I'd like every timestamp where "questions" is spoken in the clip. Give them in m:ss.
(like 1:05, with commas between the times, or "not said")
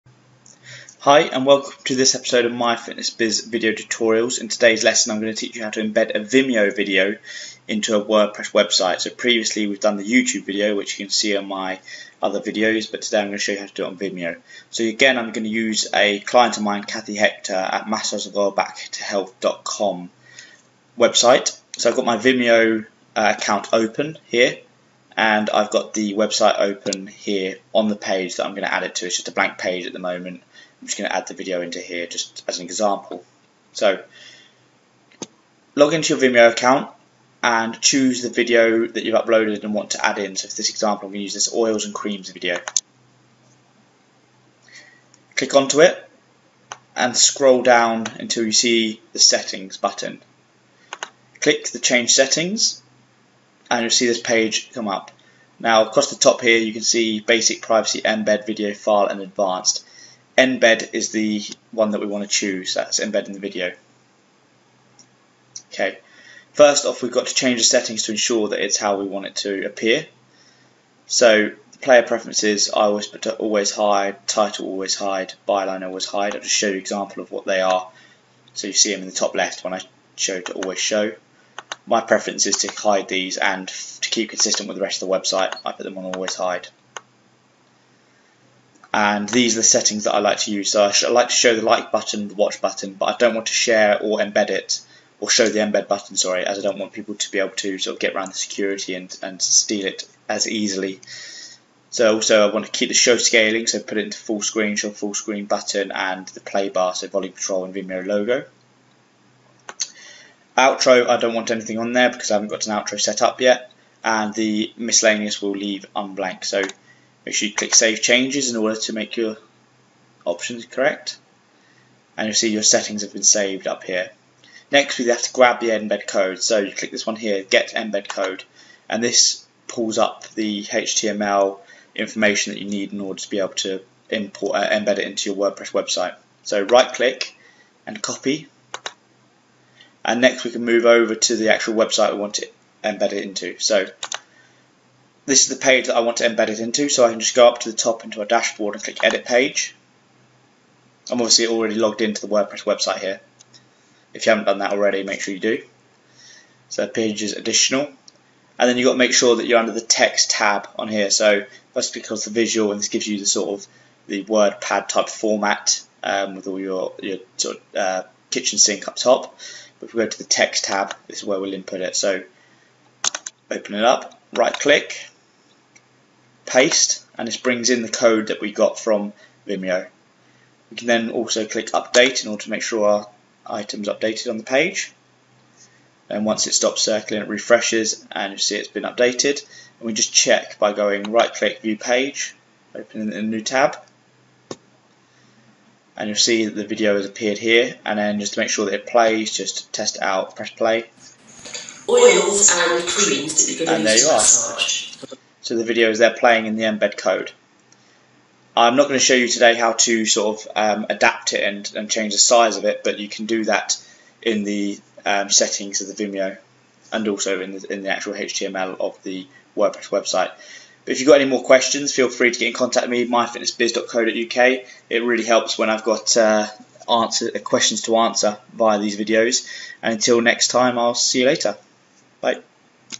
3:41, 3:47.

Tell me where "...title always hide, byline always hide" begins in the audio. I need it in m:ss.
1:14.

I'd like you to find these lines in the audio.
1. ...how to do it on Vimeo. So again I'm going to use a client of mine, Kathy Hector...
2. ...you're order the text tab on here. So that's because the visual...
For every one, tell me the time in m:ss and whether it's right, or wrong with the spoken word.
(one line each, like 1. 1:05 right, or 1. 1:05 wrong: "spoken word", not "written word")
1. 0:13 right
2. 2:39 wrong: "under", not "order".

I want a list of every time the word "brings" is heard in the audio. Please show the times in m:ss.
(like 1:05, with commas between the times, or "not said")
2:57.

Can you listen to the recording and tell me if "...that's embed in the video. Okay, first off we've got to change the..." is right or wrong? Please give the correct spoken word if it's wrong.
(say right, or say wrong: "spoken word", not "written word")
right.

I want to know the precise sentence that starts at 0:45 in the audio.
Click onto it and scroll down until you see the settings button.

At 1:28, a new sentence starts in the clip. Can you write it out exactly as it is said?
And these are the settings that I like to use.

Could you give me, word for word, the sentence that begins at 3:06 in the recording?
And once it stops circling, it refreshes and you see it's been updated.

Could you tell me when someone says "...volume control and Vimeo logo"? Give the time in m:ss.
1:47.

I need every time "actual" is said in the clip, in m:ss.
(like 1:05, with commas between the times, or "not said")
2:21, 3:37.